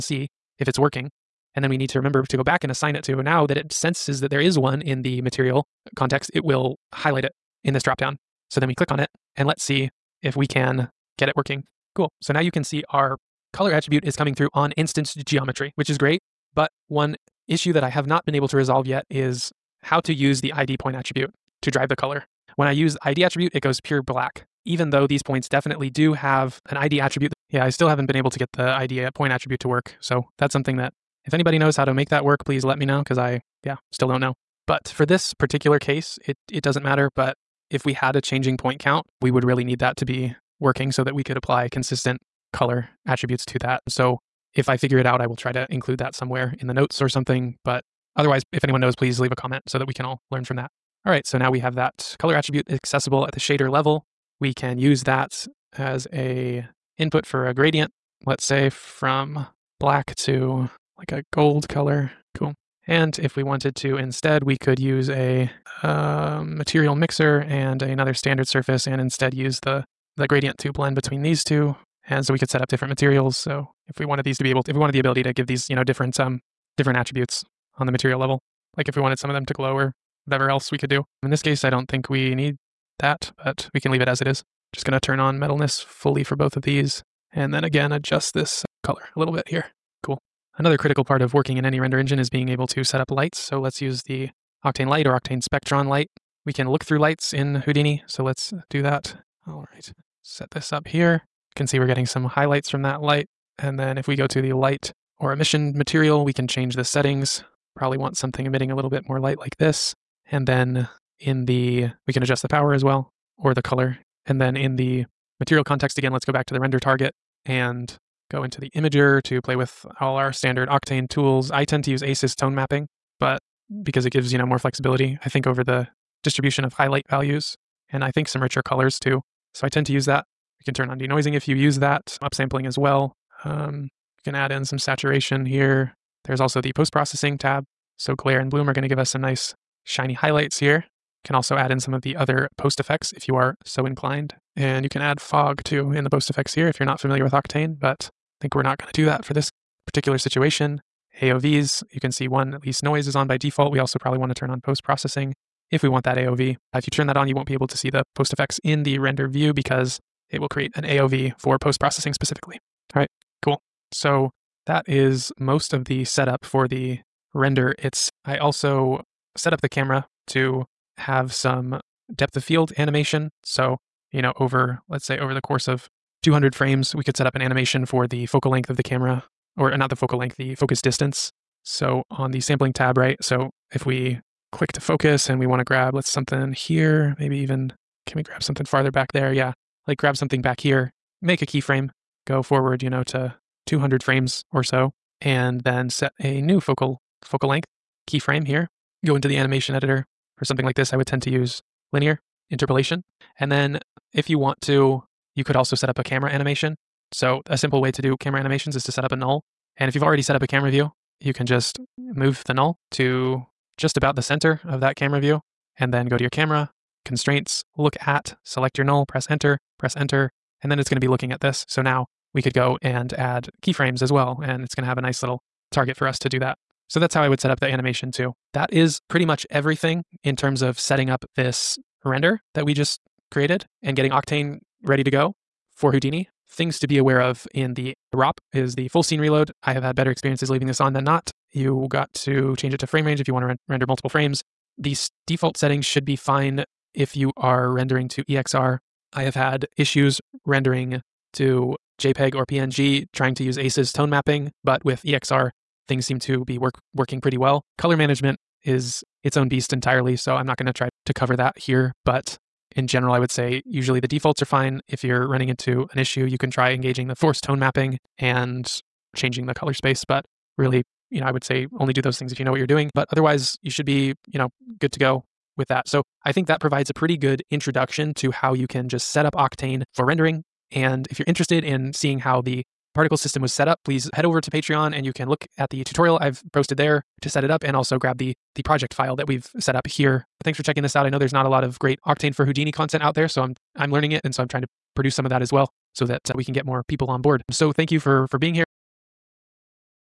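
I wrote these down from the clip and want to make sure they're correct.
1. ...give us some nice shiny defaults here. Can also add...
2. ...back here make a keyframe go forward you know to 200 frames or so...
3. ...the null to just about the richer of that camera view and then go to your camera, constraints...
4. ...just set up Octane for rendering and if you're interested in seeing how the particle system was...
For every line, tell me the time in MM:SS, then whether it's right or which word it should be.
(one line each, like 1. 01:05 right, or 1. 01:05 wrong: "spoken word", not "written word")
1. 02:18 wrong: "highlights", not "defaults"
2. 03:10 right
3. 03:32 wrong: "center", not "richer"
4. 04:38 right.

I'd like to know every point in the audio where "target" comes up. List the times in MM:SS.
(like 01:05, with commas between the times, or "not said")
01:56, 03:45.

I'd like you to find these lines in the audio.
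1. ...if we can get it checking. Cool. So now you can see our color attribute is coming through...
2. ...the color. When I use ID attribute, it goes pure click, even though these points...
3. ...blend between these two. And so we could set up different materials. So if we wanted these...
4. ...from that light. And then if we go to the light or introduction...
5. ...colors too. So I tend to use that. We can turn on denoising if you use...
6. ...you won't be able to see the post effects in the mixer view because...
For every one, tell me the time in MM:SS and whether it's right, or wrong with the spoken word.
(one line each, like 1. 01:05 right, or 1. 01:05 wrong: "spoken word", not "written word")
1. 00:10 wrong: "working", not "checking"
2. 00:21 wrong: "black", not "click"
3. 01:10 right
4. 01:42 wrong: "emission", not "introduction"
5. 02:08 right
6. 02:37 wrong: "render", not "mixer".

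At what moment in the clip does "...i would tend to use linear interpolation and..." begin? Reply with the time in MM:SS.
03:20.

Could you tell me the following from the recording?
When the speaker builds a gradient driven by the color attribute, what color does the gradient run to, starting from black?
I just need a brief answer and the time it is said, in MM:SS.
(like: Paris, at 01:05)
gold, at 01:01.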